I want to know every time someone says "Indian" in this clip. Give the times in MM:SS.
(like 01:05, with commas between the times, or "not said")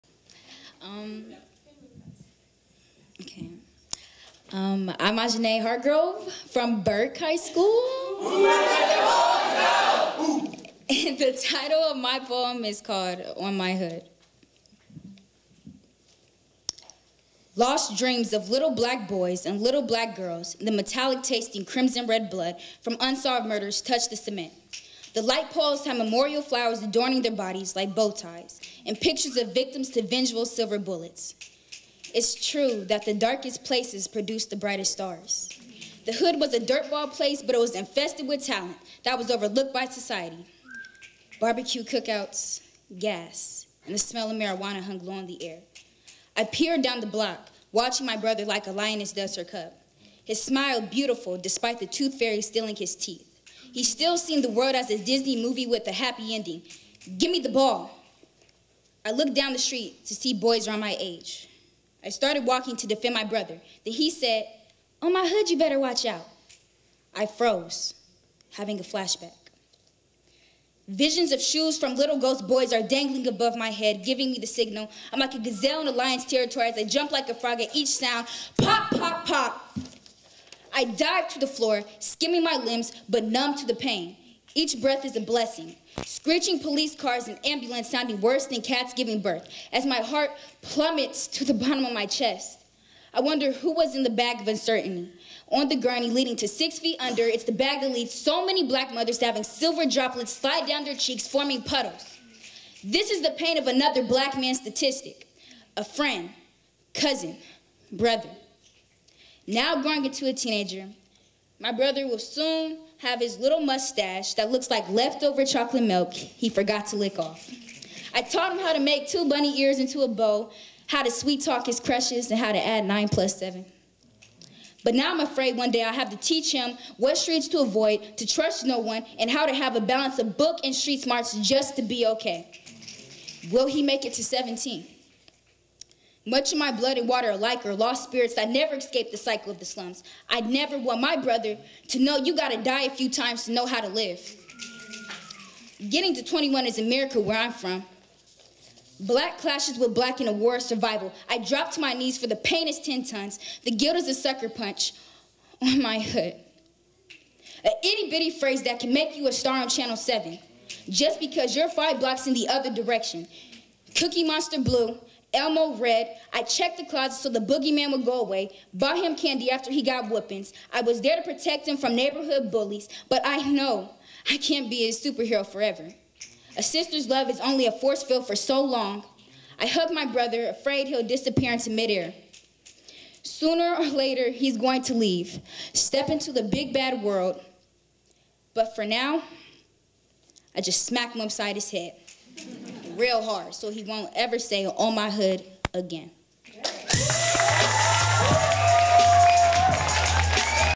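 not said.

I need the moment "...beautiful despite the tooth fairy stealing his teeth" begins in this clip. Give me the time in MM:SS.
00:50.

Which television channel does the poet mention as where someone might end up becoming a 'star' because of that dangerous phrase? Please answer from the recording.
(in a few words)
Channel 7.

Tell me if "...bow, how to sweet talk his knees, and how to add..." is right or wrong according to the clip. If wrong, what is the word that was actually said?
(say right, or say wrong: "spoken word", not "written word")
wrong: "crushes", not "knees".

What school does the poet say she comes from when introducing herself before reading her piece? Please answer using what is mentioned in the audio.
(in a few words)
Burke High School.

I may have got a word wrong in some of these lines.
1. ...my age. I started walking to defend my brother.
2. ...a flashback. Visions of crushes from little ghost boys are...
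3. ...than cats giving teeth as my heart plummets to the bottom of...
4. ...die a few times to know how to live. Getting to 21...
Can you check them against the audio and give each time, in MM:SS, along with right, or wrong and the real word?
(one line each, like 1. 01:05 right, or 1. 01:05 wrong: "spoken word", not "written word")
1. 01:00 right
2. 01:08 wrong: "shoes", not "crushes"
3. 01:28 wrong: "birth", not "teeth"
4. 02:22 right.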